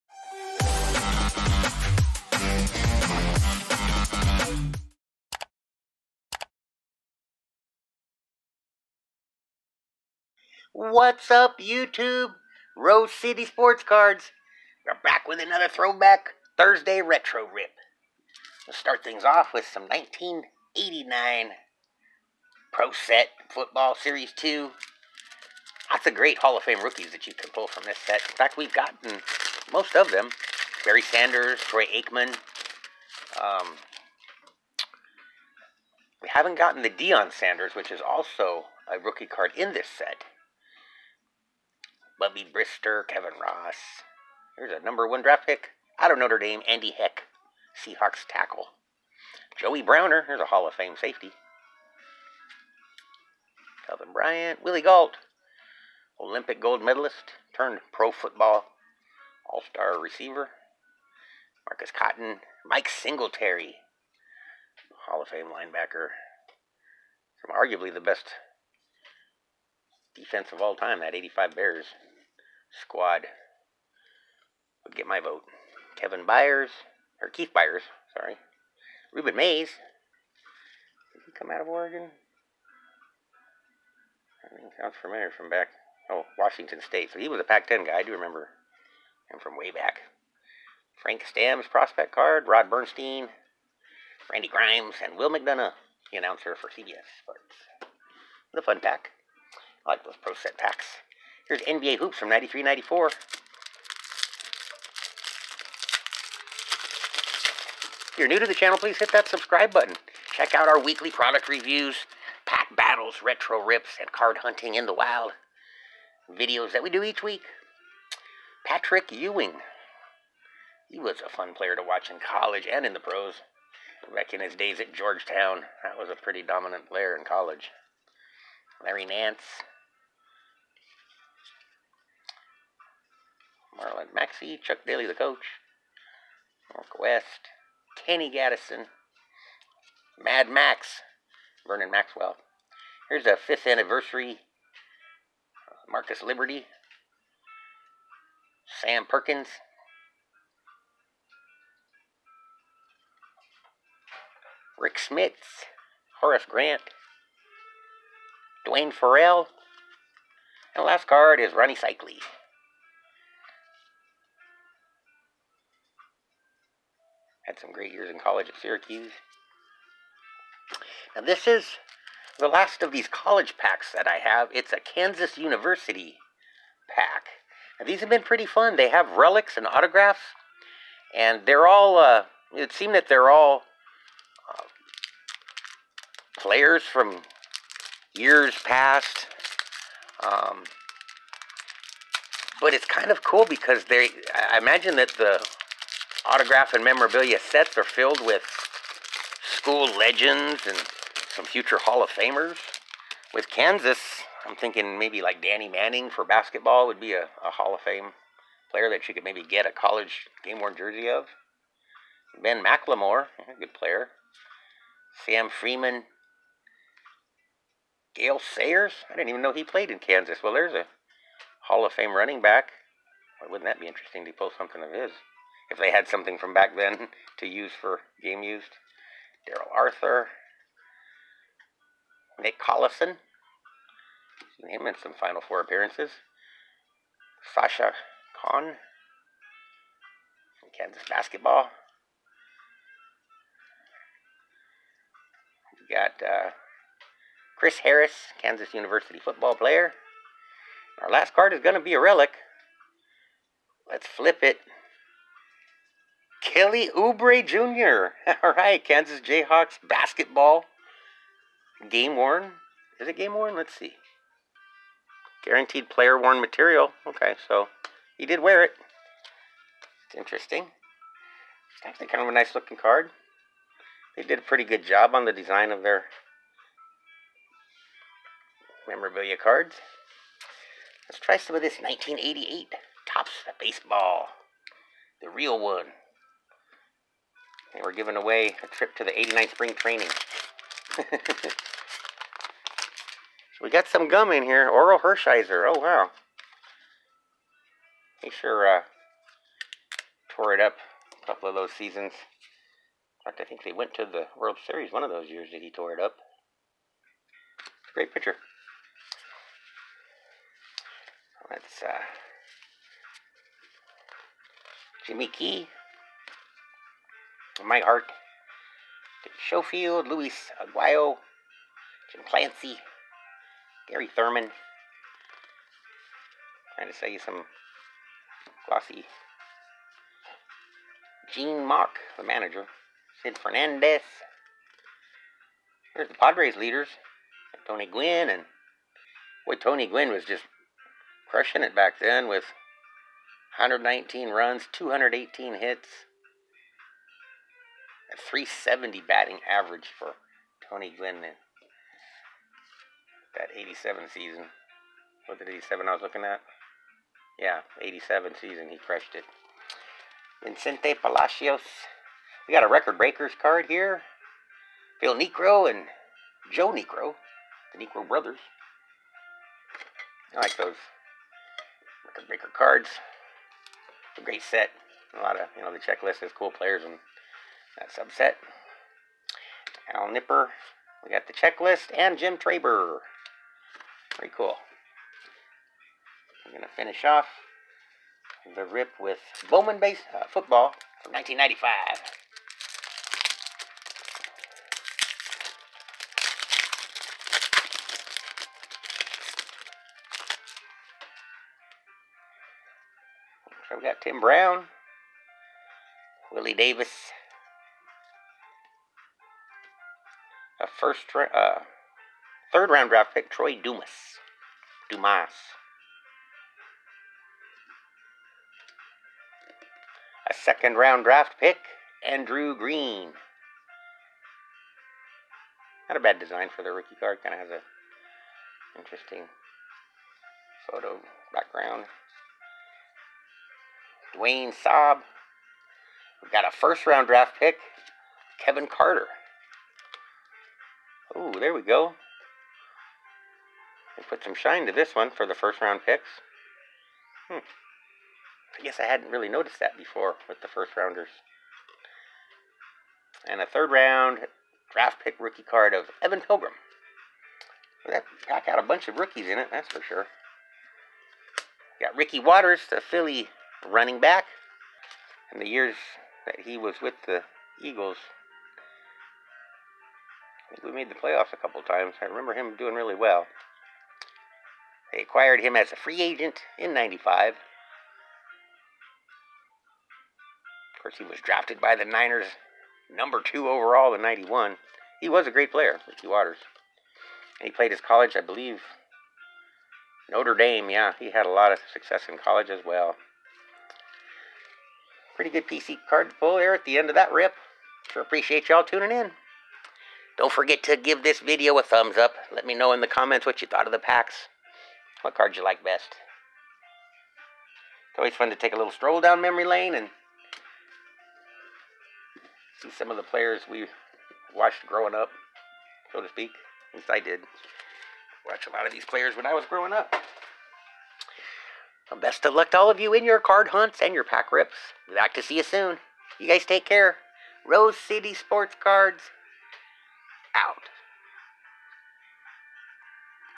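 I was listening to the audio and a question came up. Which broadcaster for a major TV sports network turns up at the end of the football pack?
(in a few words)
Will McDonough.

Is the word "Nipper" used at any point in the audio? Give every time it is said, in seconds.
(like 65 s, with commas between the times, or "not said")
380 s.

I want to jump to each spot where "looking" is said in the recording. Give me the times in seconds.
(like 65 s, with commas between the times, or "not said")
272 s, 356 s.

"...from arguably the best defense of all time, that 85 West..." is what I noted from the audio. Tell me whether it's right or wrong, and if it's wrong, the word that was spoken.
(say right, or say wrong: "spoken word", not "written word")
wrong: "Bears", not "West".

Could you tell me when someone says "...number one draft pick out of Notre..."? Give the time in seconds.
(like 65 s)
44 s.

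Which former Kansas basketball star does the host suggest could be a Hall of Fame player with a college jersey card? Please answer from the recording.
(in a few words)
Danny Manning.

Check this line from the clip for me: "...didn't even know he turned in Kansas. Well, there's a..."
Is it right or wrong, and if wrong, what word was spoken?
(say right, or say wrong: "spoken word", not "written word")
wrong: "played", not "turned".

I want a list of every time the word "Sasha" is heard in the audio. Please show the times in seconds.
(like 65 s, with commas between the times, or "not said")
237 s.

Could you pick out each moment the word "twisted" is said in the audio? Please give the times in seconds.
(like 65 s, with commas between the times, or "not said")
not said.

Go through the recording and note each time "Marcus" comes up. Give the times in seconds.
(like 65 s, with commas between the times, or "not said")
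61 s, 145 s.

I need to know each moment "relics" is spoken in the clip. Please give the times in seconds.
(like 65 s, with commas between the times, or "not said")
179 s, 251 s.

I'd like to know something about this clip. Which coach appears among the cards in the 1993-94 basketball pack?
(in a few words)
Chuck Daly.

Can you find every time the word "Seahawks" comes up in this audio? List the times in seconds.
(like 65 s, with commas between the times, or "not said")
47 s.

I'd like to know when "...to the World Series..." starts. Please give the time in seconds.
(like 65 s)
303 s.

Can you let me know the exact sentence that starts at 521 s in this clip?
best of luck to all of you in your card hunts and your pack rips.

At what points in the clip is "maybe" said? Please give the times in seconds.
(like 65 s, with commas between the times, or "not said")
204 s, 209 s.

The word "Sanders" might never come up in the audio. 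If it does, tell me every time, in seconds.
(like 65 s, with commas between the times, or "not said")
31 s, 37 s.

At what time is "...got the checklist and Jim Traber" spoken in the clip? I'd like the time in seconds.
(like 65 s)
381 s.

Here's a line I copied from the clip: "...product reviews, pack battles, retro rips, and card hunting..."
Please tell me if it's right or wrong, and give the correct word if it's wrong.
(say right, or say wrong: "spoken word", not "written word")
right.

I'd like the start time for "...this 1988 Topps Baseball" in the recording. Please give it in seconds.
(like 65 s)
281 s.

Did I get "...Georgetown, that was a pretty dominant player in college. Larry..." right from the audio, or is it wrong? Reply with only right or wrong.
right.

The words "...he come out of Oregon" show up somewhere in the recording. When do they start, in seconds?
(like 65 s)
81 s.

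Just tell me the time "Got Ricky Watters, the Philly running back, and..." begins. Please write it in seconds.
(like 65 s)
461 s.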